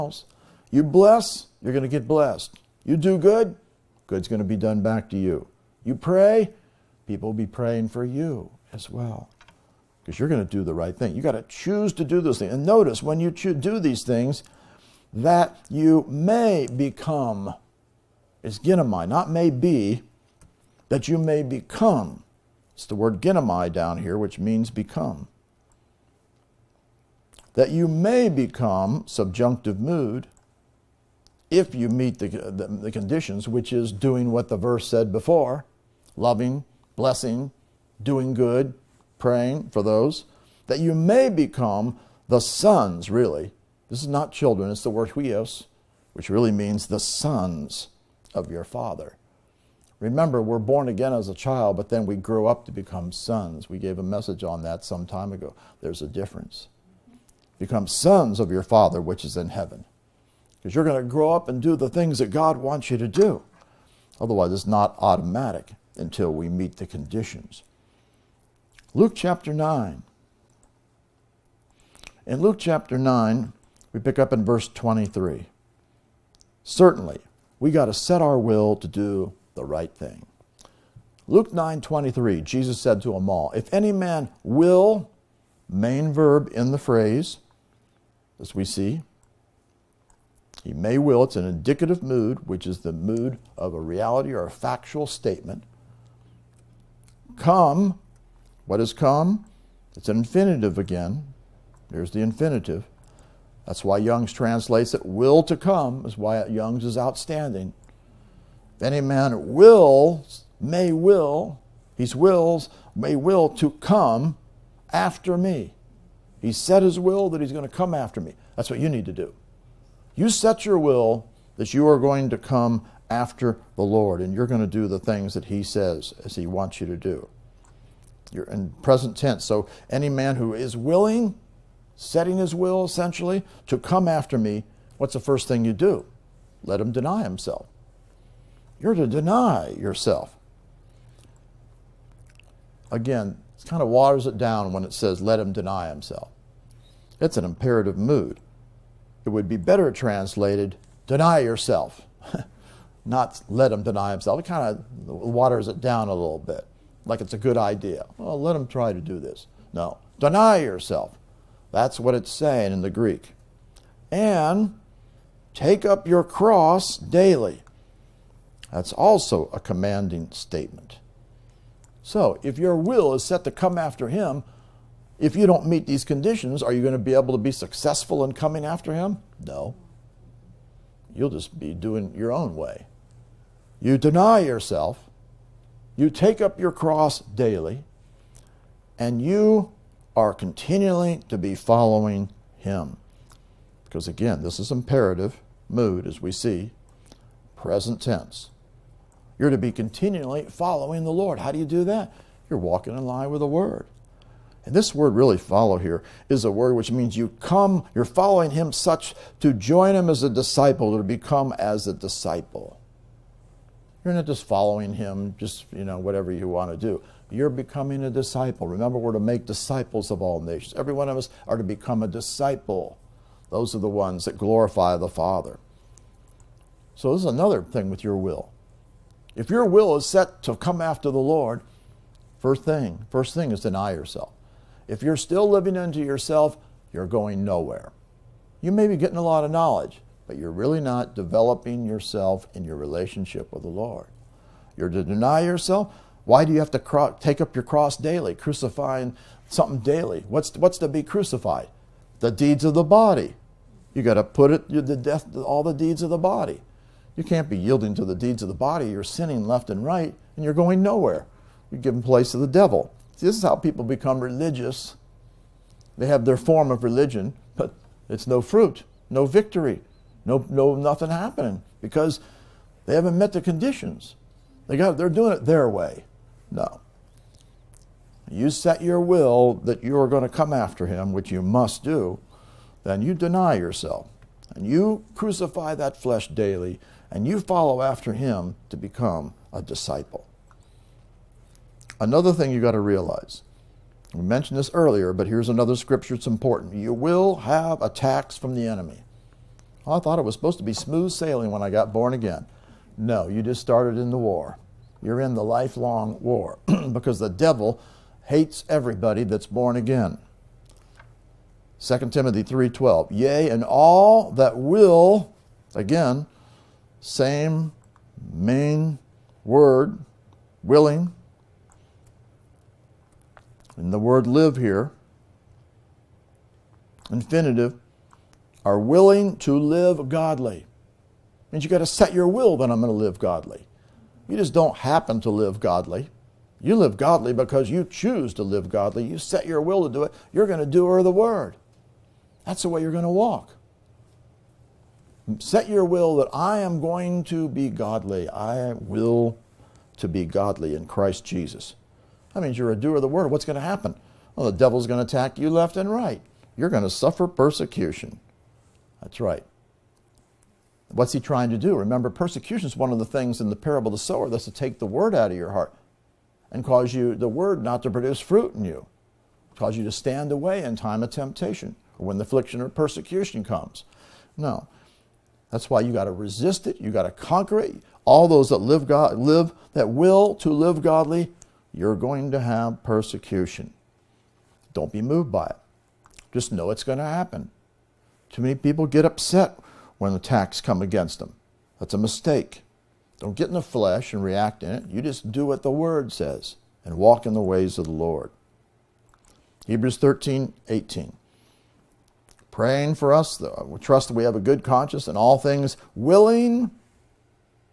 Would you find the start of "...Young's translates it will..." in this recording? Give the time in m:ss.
1:43.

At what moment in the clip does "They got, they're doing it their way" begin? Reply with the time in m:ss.
4:34.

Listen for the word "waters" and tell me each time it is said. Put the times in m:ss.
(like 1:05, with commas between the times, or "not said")
2:23, 2:35.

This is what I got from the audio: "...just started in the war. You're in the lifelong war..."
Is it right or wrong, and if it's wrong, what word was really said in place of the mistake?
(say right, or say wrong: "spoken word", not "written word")
right.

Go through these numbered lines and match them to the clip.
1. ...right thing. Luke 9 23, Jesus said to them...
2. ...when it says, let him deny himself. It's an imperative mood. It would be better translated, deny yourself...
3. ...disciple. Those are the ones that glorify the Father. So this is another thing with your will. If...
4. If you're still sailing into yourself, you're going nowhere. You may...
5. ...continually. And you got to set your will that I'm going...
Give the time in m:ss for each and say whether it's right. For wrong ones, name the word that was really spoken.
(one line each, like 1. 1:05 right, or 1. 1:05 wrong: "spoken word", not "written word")
1. 1:19 right
2. 2:24 right
3. 3:42 right
4. 3:54 wrong: "living", not "sailing"
5. 5:30 wrong: "godly", not "continually".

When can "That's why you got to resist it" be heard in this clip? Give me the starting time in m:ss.
6:15.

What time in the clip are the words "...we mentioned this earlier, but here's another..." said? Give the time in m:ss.
4:54.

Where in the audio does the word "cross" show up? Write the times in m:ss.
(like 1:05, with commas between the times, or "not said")
2:46, 3:06, 4:07.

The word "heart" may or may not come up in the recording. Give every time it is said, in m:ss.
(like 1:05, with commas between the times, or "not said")
6:05.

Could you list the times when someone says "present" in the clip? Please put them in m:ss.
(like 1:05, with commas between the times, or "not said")
2:08, 3:17.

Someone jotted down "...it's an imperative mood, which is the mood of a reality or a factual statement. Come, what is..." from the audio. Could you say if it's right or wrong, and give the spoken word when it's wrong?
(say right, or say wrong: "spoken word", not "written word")
wrong: "indicative", not "imperative".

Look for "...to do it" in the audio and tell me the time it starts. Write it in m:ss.
5:39.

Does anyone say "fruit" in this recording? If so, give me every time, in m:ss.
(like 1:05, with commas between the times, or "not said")
4:28, 6:08.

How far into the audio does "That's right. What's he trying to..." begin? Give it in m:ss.
5:59.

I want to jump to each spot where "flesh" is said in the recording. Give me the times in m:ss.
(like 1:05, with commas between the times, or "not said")
4:45, 6:33.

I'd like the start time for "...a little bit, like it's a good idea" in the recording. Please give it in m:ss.
2:36.